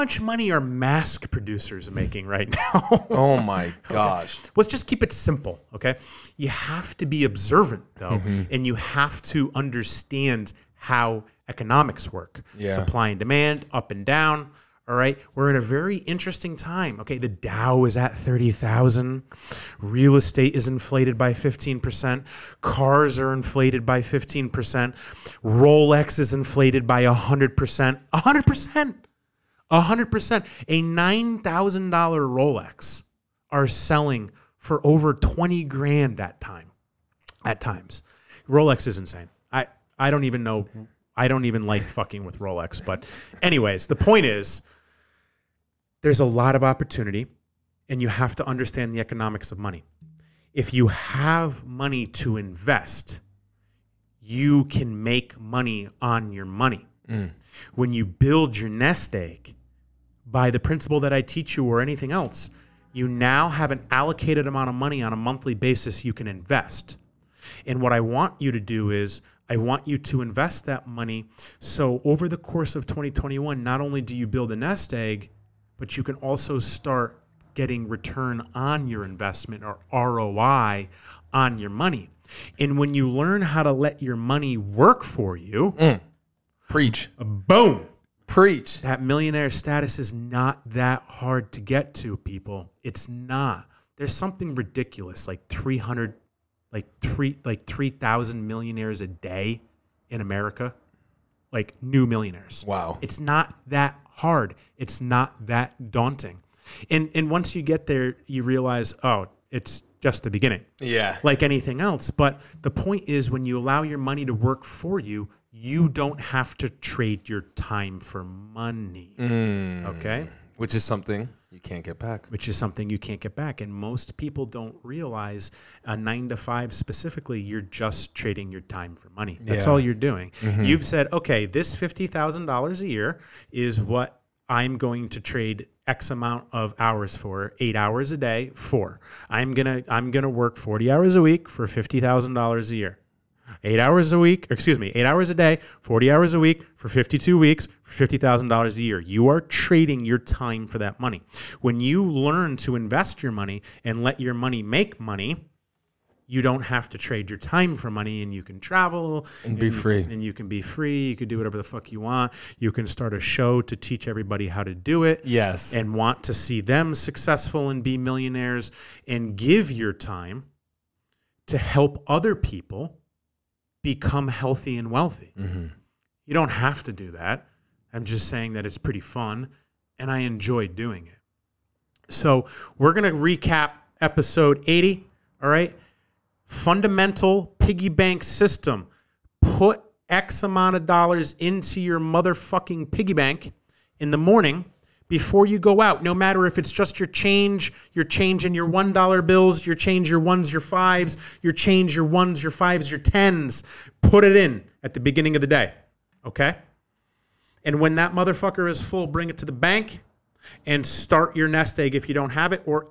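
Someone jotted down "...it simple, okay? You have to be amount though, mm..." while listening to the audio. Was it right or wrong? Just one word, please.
wrong.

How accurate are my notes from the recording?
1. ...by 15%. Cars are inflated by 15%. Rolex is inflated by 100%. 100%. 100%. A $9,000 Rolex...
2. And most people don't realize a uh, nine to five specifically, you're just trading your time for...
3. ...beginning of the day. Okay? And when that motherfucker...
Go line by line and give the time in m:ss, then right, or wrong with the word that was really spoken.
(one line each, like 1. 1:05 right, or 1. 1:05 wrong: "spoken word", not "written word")
1. 0:21 right
2. 2:03 right
3. 3:24 right.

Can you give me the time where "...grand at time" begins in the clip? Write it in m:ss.
0:35.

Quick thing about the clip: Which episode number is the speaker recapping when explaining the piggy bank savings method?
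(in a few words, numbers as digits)
80.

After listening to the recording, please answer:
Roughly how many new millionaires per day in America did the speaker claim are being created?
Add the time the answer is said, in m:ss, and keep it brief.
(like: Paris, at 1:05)
3,000, at 1:37.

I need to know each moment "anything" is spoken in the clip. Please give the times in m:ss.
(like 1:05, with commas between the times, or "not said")
1:01, 1:51.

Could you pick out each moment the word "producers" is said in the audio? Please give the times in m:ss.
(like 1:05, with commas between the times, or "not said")
0:01.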